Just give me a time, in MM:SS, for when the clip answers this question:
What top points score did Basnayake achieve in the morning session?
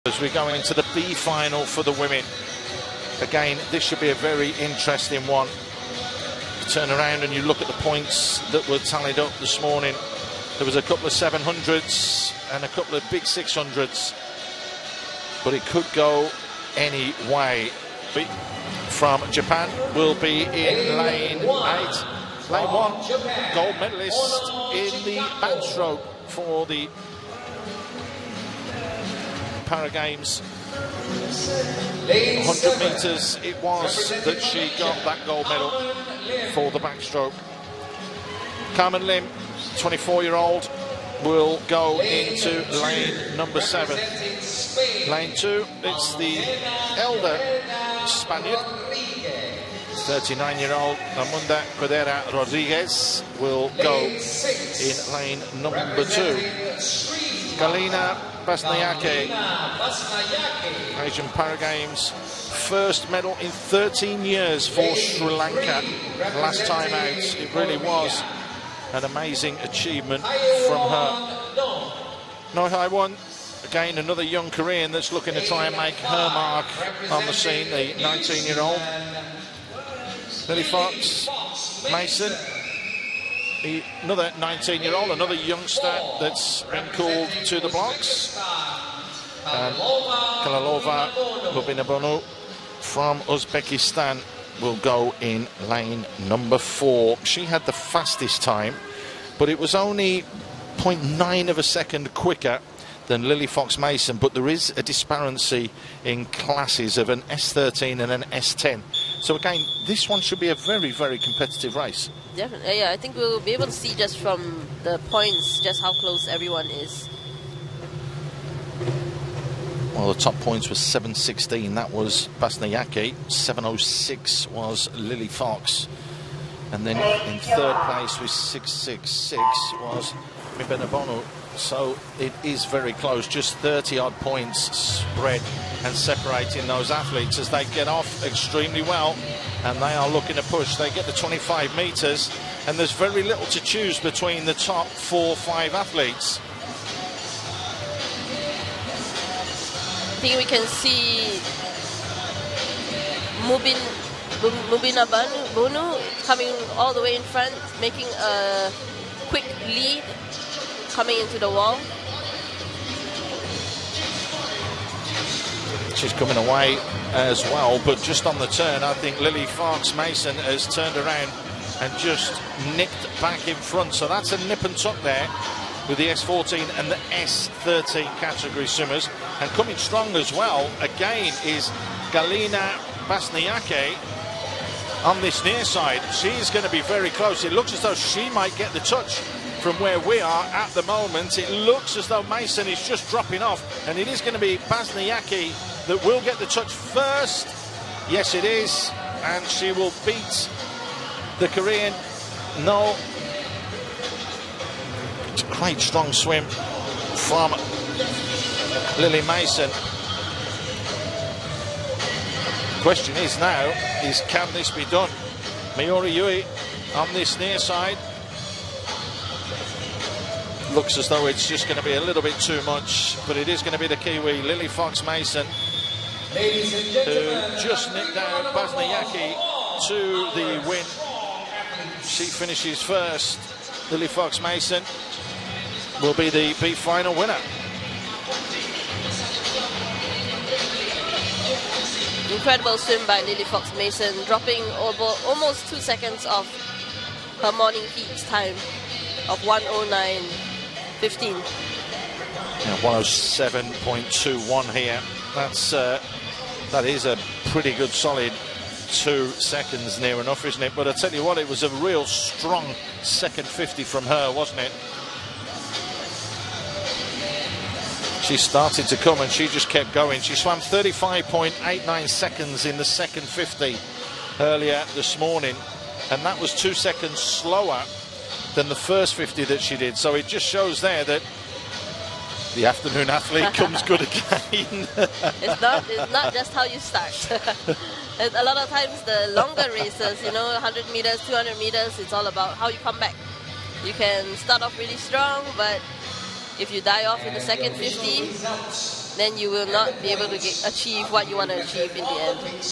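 02:00.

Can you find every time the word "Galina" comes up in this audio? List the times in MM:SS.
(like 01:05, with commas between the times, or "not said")
00:57, 03:02.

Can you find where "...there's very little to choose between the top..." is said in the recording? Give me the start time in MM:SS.
02:22.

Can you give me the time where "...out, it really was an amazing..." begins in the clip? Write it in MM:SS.
01:06.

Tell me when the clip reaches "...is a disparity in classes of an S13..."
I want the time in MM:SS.
01:44.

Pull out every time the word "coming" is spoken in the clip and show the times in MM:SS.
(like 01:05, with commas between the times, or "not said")
02:36, 02:40, 02:46, 02:59.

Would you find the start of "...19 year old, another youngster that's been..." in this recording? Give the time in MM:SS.
01:24.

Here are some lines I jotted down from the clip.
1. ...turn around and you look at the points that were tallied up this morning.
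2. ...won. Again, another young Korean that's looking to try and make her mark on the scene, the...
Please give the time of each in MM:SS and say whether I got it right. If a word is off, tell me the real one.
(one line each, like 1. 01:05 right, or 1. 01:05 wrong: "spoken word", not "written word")
1. 00:06 right
2. 01:12 right.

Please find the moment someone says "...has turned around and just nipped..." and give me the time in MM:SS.
02:50.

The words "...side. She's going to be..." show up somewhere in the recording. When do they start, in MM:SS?
03:05.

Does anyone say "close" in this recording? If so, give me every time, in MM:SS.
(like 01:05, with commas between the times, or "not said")
01:55, 02:12, 03:07.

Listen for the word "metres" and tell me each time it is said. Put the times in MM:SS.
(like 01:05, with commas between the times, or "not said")
00:32, 02:21.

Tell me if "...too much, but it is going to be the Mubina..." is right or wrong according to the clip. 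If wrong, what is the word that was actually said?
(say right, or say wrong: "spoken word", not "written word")
wrong: "Kiwi", not "Mubina".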